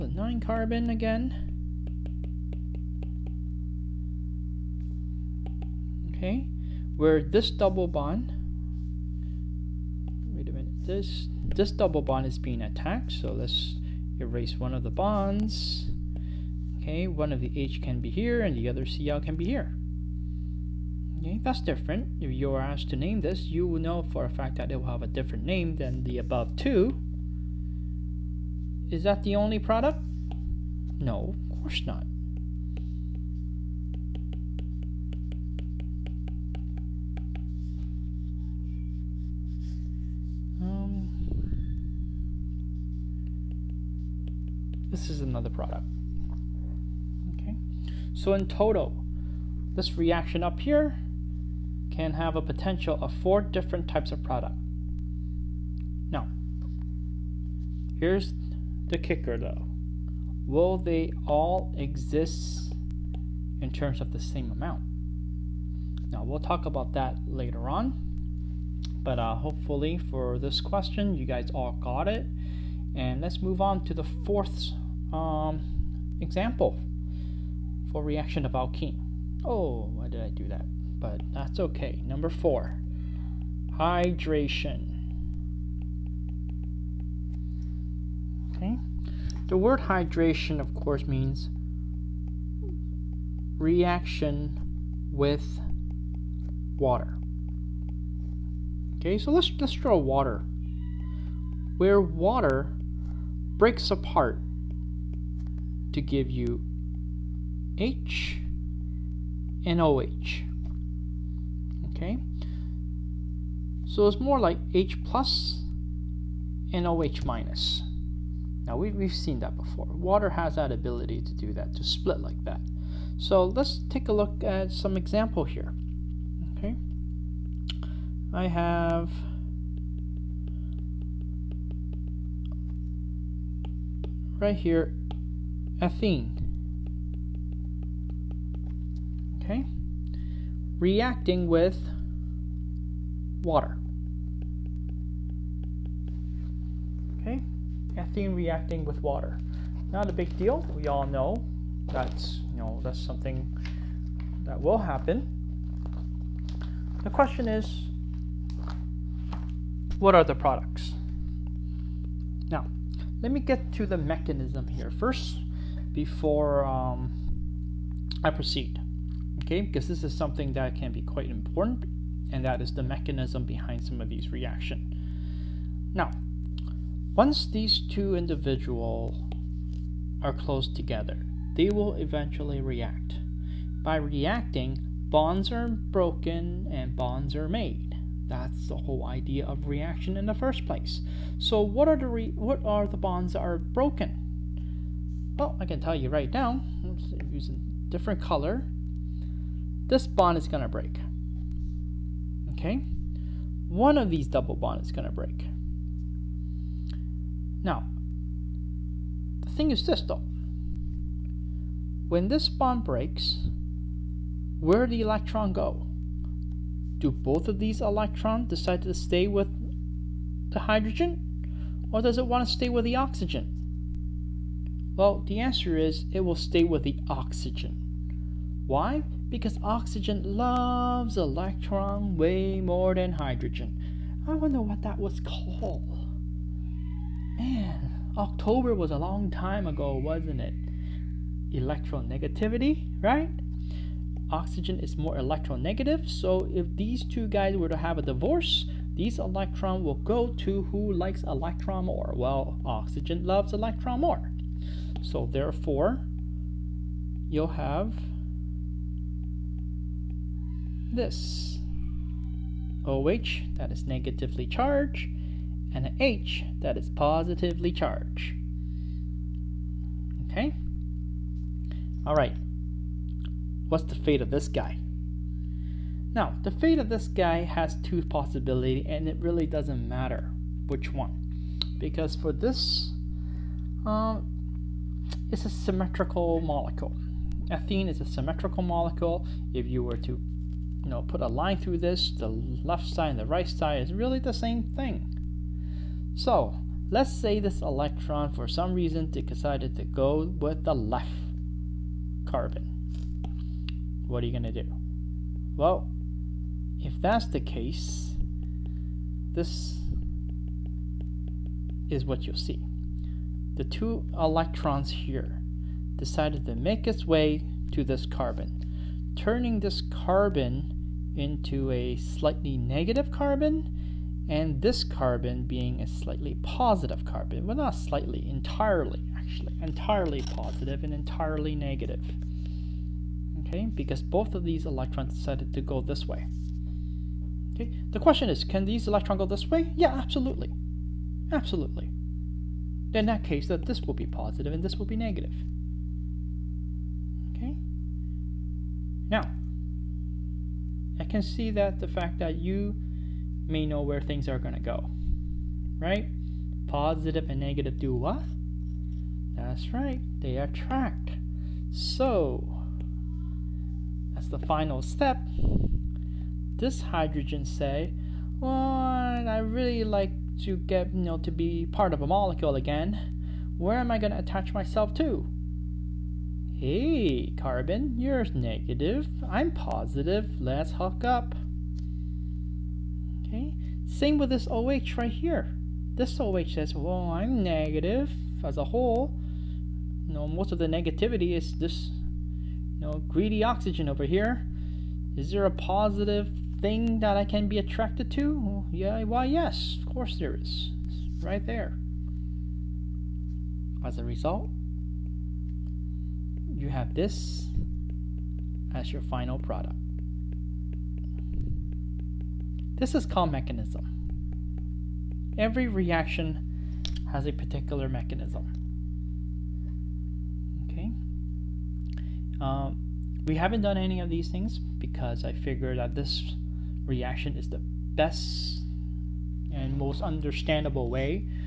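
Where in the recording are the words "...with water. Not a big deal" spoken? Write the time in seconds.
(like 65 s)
148 s.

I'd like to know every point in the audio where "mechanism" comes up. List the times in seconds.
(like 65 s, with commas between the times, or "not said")
163 s, 172 s, 413 s, 417 s.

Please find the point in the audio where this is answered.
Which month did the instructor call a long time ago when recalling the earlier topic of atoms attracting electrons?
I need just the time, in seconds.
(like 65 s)
238 s.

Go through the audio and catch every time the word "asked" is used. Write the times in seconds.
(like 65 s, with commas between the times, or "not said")
22 s.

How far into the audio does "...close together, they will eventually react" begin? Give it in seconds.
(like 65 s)
180 s.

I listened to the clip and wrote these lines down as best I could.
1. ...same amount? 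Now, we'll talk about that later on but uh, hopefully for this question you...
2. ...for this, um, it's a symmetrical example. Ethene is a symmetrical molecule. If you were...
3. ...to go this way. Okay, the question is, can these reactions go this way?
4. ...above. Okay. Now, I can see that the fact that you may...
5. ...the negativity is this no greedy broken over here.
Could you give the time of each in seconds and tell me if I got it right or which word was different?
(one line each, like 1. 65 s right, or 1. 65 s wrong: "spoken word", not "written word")
1. 64 s right
2. 282 s wrong: "molecule", not "example"
3. 335 s wrong: "electrons", not "reactions"
4. 344 s wrong: "negative", not "above"
5. 390 s wrong: "oxygen", not "broken".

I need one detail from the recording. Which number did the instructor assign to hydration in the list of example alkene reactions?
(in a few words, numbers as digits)
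4.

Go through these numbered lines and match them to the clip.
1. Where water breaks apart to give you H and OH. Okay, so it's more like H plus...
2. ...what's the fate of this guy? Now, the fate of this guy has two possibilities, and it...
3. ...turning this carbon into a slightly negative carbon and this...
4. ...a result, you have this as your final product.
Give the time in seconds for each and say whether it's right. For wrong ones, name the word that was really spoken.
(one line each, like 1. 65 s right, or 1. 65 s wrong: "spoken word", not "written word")
1. 101 s right
2. 273 s right
3. 319 s right
4. 403 s right.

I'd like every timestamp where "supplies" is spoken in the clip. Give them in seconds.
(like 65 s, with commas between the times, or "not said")
not said.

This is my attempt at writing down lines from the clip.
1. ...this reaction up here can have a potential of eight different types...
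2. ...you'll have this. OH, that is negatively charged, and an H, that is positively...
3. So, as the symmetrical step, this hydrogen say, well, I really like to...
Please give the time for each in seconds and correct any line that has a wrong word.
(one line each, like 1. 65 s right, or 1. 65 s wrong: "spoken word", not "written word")
1. 49 s wrong: "four", not "eight"
2. 257 s right
3. 361 s wrong: "final", not "symmetrical".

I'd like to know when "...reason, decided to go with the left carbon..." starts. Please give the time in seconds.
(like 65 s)
298 s.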